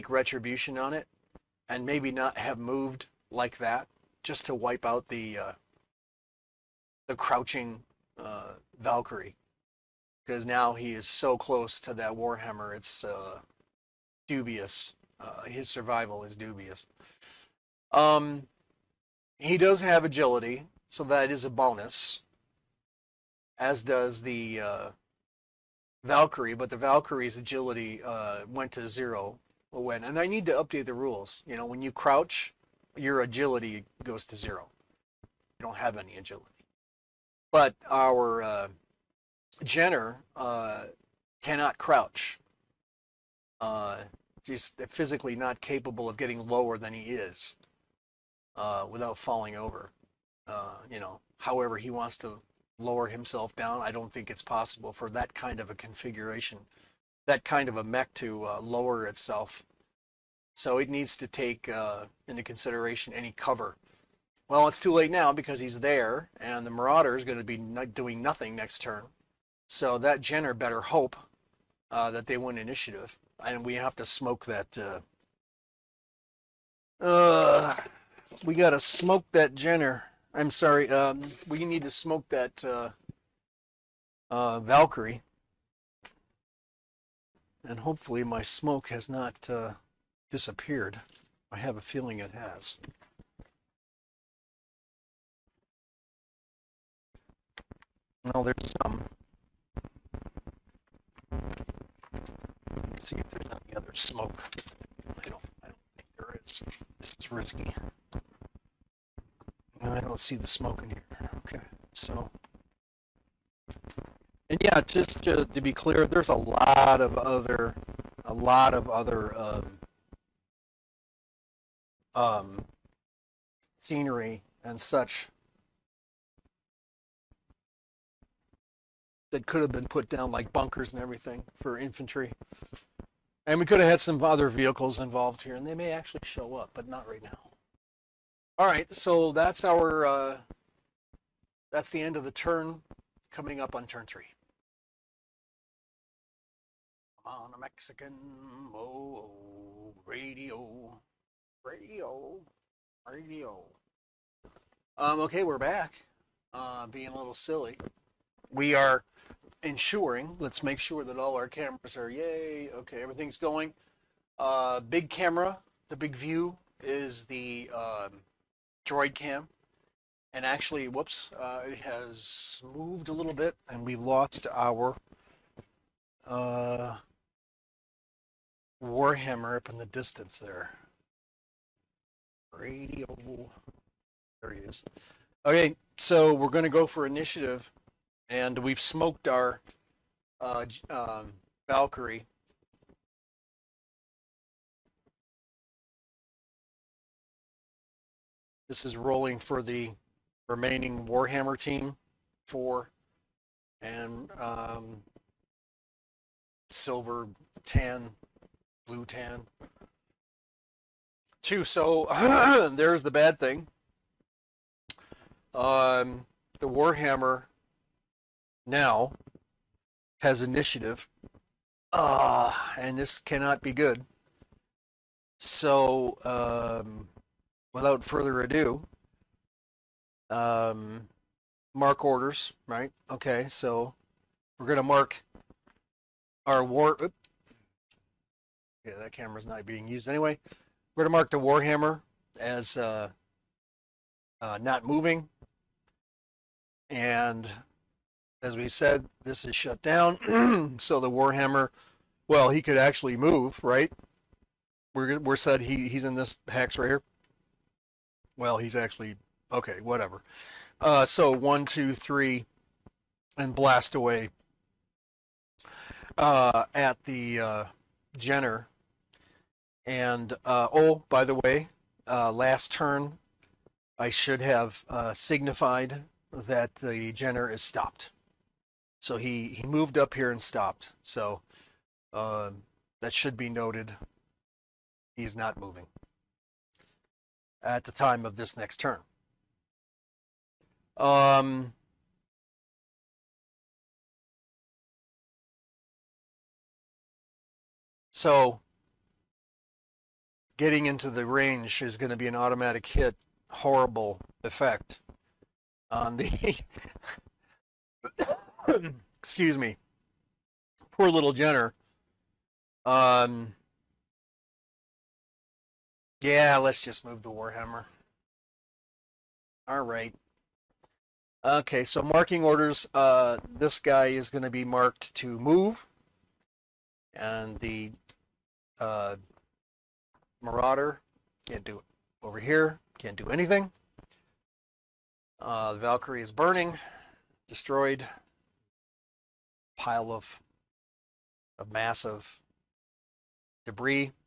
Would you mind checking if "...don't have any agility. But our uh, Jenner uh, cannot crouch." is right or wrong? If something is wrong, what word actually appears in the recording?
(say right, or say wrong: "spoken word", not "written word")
right.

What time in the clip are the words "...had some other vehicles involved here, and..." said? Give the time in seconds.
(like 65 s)
133 s.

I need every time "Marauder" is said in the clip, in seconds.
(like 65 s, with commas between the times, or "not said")
66 s, 330 s.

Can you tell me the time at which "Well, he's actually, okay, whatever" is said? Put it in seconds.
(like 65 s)
258 s.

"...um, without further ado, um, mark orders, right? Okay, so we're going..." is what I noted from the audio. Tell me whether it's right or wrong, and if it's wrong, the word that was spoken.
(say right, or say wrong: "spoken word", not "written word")
right.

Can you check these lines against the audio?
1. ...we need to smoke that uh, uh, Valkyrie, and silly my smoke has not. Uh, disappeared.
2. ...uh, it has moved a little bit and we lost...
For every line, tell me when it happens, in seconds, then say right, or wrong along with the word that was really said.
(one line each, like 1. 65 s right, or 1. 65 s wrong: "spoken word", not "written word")
1. 81 s wrong: "hopefully", not "silly"
2. 171 s right.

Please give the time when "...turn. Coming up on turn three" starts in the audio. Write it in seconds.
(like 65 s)
142 s.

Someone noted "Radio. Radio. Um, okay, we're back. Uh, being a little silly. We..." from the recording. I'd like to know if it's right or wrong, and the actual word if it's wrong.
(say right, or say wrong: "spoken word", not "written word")
right.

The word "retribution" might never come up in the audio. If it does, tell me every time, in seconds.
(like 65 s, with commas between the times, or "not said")
0 s.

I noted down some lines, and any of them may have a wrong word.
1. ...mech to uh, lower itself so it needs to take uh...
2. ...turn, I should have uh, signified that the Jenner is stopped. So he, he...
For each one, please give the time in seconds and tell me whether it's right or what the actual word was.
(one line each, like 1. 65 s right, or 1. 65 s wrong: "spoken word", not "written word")
1. 57 s right
2. 272 s right.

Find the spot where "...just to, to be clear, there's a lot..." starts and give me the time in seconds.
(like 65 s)
114 s.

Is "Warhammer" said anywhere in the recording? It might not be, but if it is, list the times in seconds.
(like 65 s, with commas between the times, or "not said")
12 s, 178 s, 201 s, 216 s, 241 s, 251 s, 317 s.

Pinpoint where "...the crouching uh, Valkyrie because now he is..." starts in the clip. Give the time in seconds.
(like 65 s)
7 s.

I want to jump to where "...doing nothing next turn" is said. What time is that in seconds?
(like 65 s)
67 s.